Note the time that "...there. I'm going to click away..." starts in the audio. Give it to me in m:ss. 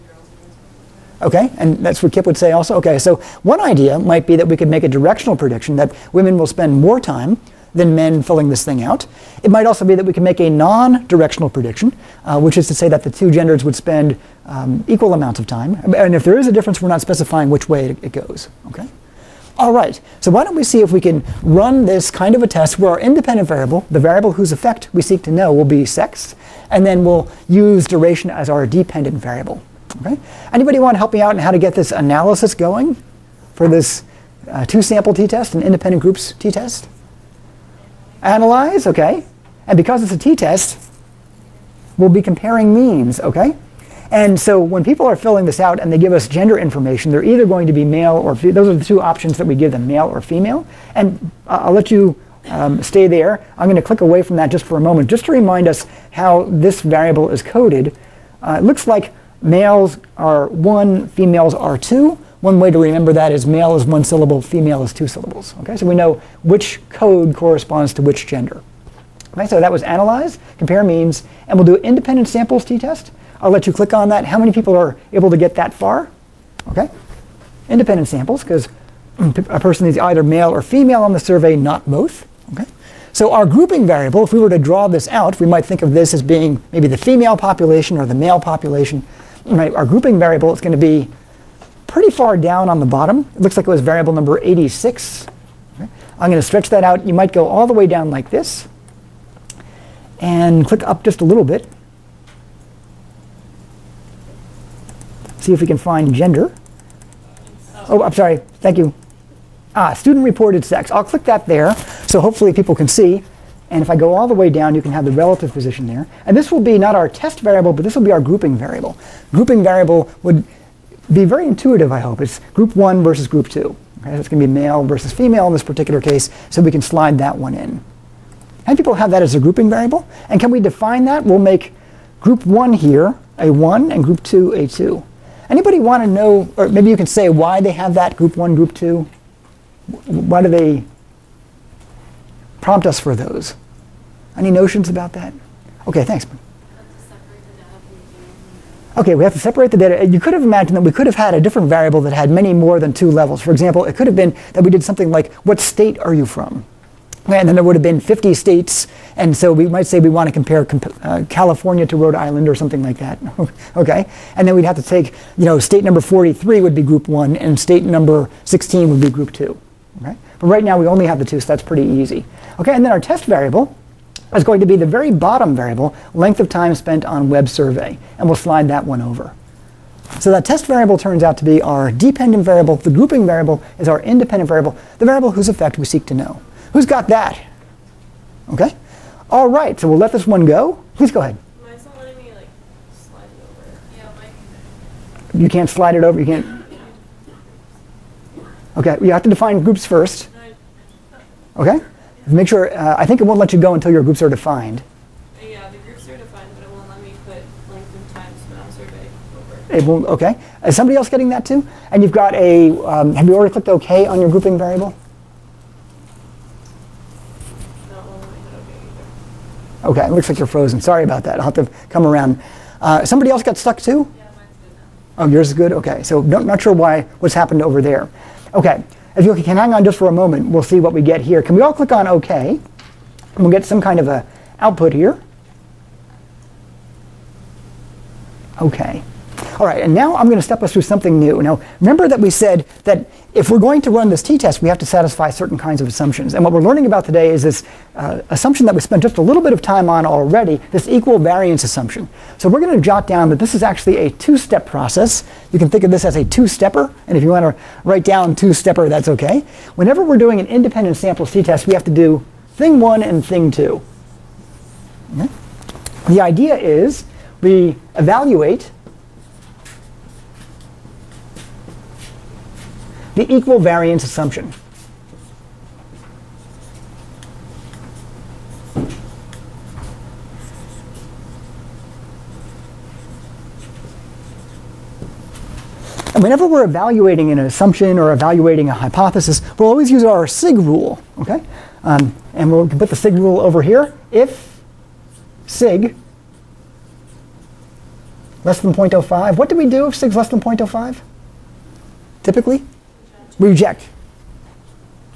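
0:53.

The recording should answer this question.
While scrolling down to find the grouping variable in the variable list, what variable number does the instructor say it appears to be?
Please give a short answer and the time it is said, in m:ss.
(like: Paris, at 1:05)
86, at 1:34.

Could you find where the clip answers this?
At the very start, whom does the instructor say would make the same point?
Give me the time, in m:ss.
0:02.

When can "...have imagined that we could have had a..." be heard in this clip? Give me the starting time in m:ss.
2:30.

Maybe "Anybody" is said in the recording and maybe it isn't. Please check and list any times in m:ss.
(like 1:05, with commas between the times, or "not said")
0:30, 2:15.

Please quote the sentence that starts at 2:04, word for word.
Okay, so it's going to be male versus female in this particular case, so we can slide that one in.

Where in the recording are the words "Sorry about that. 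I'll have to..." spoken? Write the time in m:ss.
3:40.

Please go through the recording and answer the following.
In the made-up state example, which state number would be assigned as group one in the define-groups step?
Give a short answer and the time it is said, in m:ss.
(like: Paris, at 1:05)
43, at 2:46.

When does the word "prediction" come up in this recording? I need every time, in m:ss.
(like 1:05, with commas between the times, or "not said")
0:05, 0:11.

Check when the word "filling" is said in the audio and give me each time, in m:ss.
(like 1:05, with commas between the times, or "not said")
0:08, 0:45.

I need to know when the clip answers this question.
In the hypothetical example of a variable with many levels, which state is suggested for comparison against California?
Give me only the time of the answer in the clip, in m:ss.
2:41.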